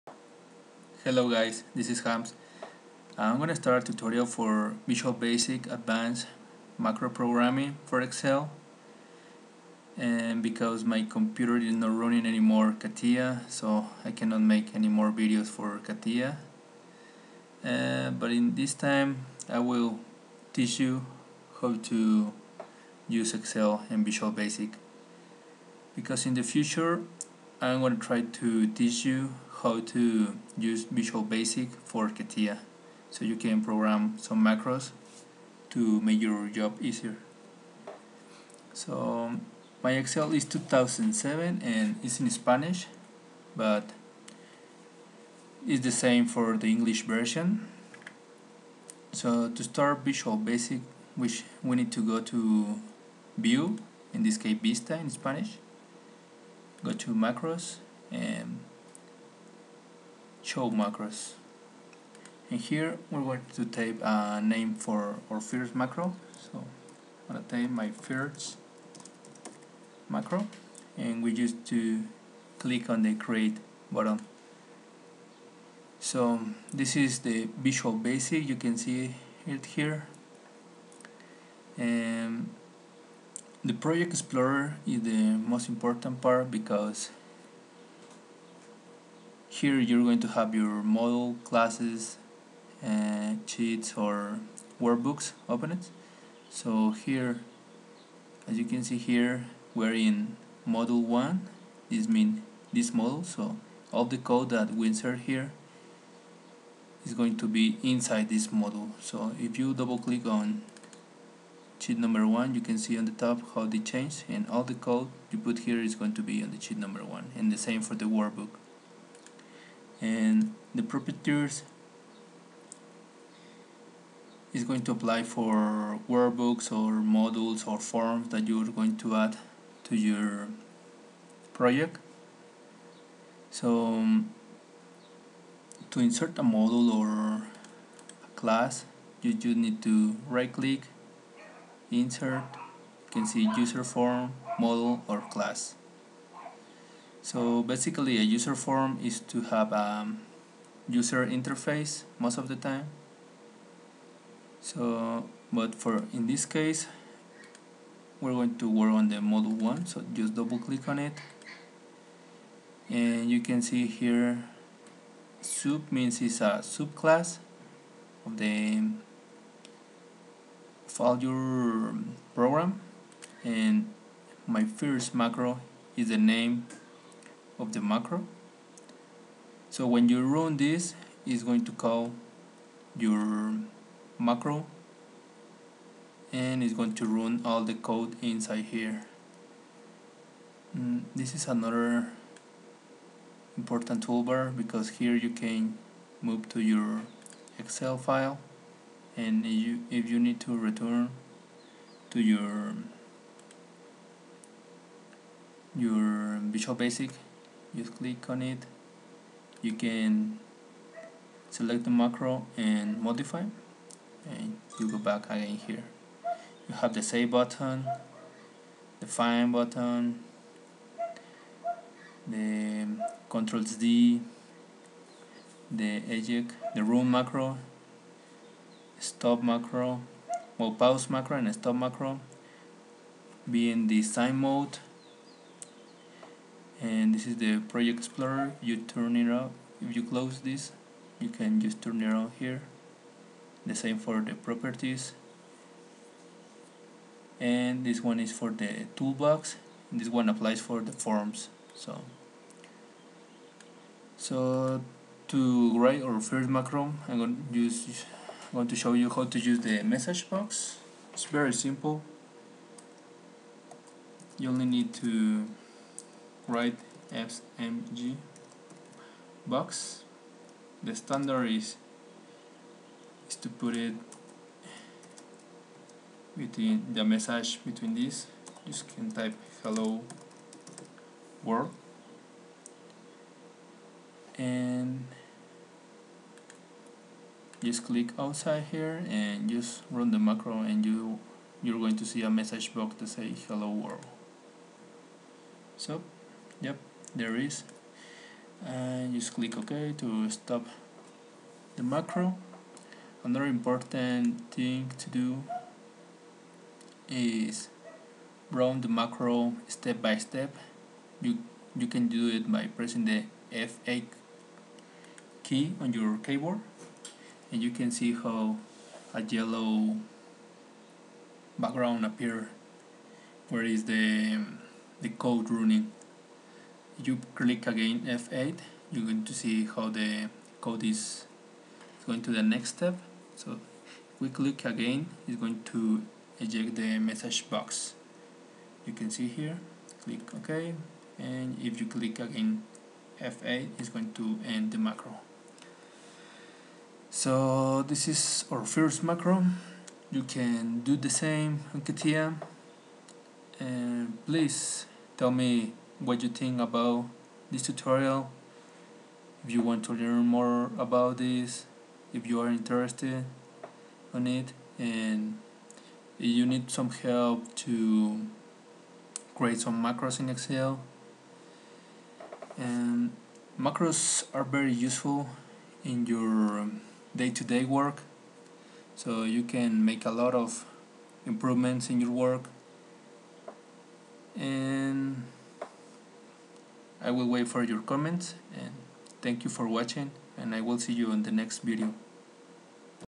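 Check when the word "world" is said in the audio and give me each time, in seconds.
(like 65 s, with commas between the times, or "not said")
281 s, 293 s.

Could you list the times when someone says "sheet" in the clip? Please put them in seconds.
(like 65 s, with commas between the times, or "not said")
93 s, 111 s, 116 s.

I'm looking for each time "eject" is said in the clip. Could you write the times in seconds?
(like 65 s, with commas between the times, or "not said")
226 s, 336 s.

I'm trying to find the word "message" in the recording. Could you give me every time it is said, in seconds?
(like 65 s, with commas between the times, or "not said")
259 s, 277 s, 292 s, 336 s.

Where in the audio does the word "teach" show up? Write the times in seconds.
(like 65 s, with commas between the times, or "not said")
20 s, 28 s.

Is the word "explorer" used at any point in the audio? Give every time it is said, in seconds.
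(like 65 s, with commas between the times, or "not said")
84 s, 237 s.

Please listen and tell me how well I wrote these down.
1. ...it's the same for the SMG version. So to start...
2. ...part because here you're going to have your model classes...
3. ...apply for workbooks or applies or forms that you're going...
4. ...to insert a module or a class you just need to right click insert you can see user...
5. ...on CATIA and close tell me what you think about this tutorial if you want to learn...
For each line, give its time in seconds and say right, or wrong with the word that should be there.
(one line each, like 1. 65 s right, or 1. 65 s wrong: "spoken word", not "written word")
1. 45 s wrong: "English", not "SMG"
2. 86 s right
3. 124 s wrong: "modules", not "applies"
4. 135 s right
5. 351 s wrong: "please", not "close".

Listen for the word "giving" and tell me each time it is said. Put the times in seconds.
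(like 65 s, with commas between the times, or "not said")
not said.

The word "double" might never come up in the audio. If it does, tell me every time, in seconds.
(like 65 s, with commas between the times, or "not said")
109 s, 160 s.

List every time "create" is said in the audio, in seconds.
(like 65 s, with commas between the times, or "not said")
73 s, 369 s.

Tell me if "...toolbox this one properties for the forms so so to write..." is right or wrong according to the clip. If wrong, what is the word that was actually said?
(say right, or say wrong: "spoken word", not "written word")
wrong: "applies", not "properties".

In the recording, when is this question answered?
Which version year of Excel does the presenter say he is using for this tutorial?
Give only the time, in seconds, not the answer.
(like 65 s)
40 s.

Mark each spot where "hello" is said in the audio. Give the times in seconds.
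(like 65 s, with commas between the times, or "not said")
1 s, 279 s, 293 s.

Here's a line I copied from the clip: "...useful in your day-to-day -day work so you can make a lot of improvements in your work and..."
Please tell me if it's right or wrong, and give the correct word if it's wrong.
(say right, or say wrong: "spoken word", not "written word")
right.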